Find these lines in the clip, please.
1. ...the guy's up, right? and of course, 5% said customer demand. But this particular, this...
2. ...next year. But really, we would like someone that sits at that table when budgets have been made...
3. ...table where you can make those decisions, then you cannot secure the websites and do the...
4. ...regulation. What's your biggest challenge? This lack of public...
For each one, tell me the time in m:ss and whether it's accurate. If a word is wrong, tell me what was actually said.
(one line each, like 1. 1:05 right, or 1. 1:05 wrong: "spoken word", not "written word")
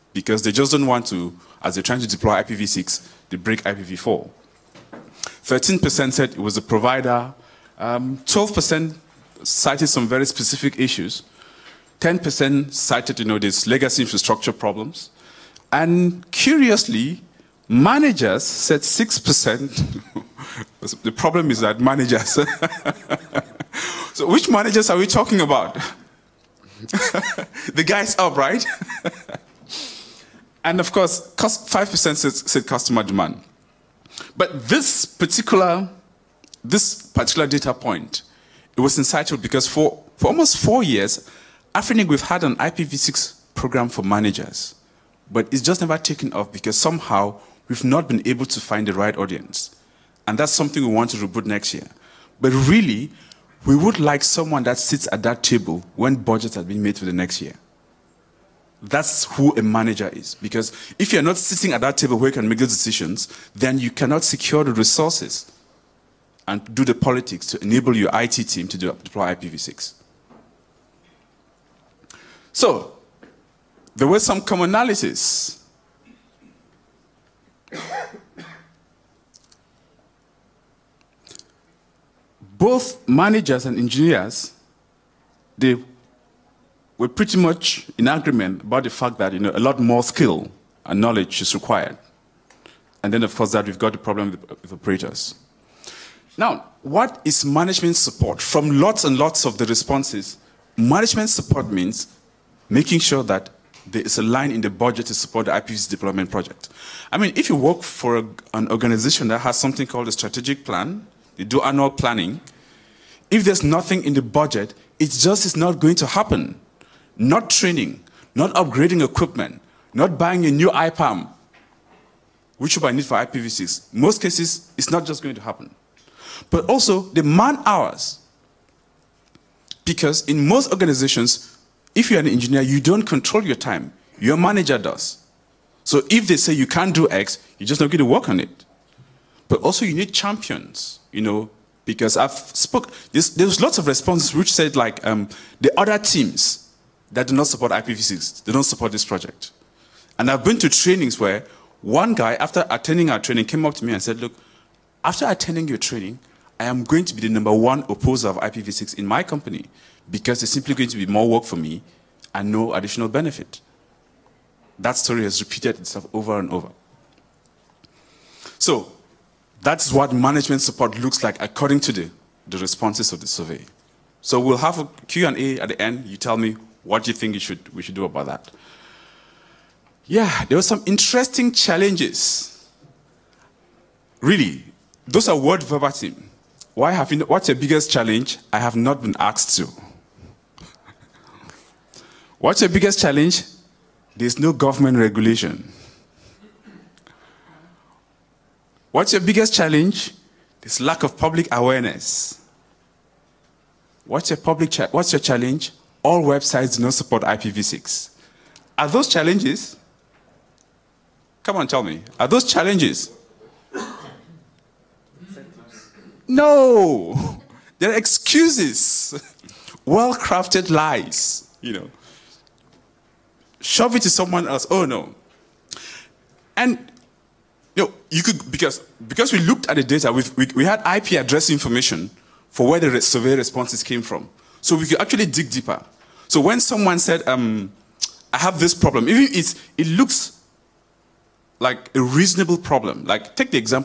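1. 0:27 right
2. 0:51 right
3. 1:01 wrong: "resources", not "websites"
4. 3:14 right.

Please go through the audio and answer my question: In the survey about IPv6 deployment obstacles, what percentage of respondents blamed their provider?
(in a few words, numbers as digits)
13%.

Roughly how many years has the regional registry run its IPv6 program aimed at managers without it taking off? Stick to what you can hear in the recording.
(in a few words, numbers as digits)
4 years.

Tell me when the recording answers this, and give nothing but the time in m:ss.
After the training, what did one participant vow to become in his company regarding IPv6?
2:37.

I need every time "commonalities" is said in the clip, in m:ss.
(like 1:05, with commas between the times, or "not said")
1:14.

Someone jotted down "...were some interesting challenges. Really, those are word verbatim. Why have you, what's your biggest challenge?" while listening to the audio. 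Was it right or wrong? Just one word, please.
right.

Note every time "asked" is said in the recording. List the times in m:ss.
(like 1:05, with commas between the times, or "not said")
3:09.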